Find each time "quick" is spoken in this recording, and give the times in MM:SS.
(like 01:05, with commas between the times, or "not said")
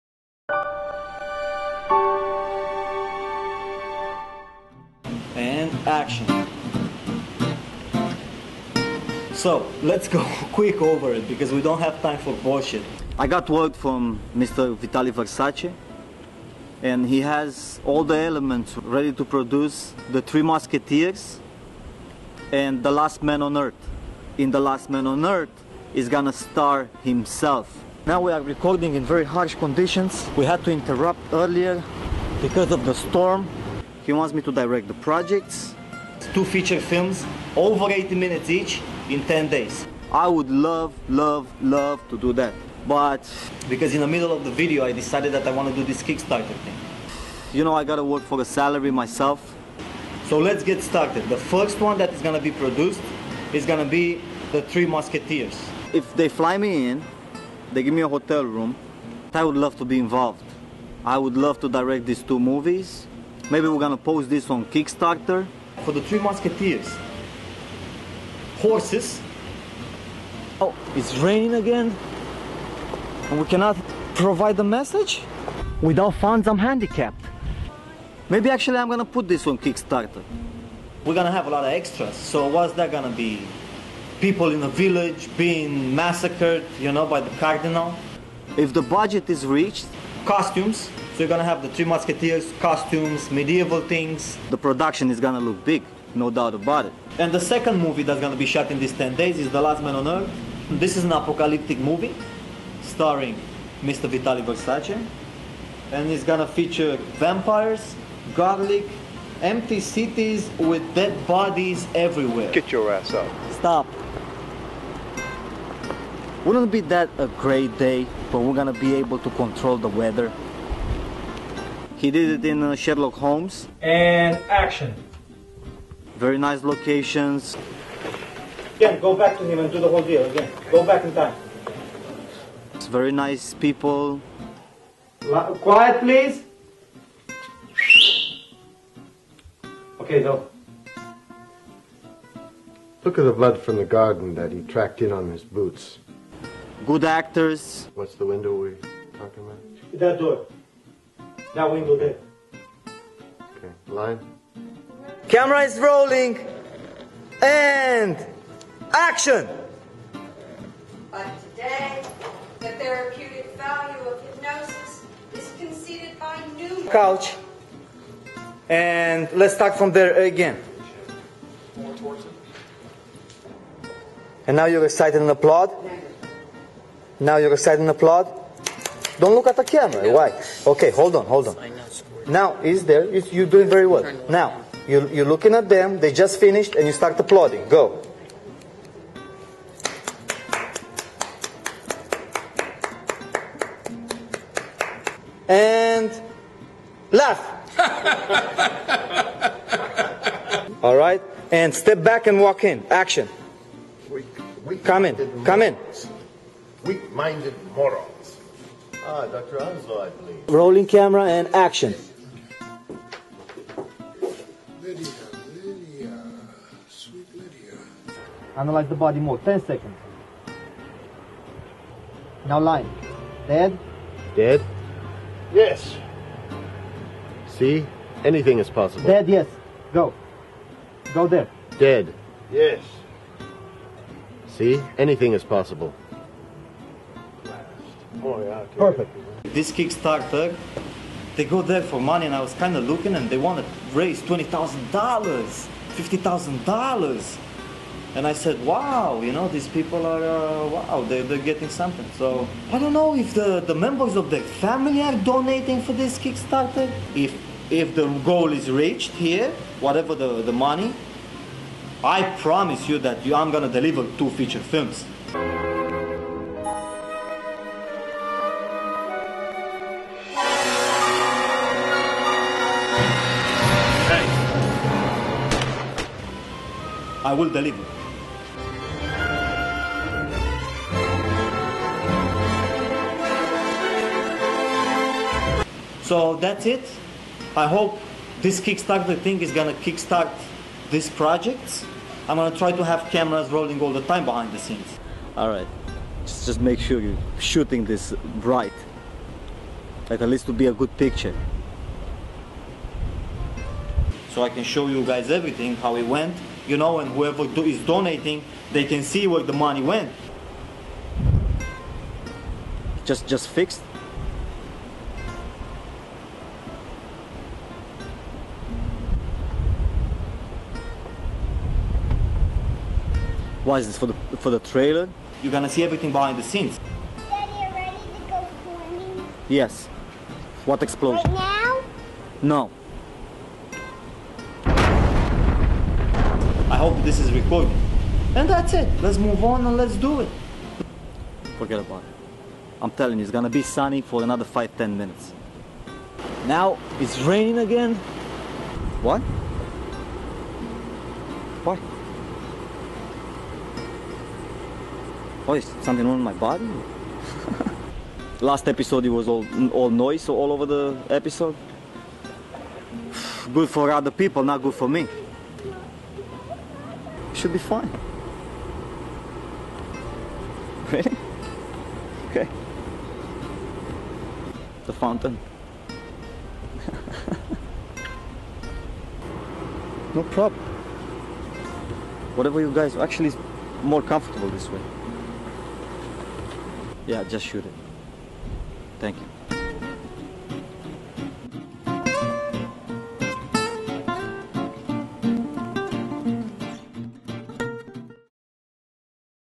00:10.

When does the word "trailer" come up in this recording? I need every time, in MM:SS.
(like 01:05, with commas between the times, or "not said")
05:24.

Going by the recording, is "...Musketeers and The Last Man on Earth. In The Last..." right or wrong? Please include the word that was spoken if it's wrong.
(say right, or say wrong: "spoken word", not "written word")
right.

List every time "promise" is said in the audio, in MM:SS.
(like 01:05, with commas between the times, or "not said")
04:22.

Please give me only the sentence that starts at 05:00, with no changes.
Like at least to be a good picture.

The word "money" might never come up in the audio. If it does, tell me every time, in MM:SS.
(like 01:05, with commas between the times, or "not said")
04:01, 04:20, 05:09.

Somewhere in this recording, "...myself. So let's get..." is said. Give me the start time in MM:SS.
00:48.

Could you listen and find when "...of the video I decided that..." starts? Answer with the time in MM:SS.
00:44.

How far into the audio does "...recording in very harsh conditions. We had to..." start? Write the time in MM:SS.
00:28.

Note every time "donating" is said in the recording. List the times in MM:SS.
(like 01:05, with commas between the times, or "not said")
04:15, 05:07.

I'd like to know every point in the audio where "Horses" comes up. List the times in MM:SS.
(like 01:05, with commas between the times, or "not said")
01:08.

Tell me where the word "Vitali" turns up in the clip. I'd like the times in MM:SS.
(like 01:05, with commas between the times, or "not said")
00:14, 01:44.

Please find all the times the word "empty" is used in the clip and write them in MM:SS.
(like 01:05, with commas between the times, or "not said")
01:49.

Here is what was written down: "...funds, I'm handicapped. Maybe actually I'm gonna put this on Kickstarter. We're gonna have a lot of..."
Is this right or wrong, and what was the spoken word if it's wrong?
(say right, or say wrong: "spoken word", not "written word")
right.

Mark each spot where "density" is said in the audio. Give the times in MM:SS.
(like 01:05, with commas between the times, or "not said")
not said.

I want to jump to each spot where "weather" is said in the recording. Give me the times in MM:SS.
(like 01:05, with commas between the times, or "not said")
01:59.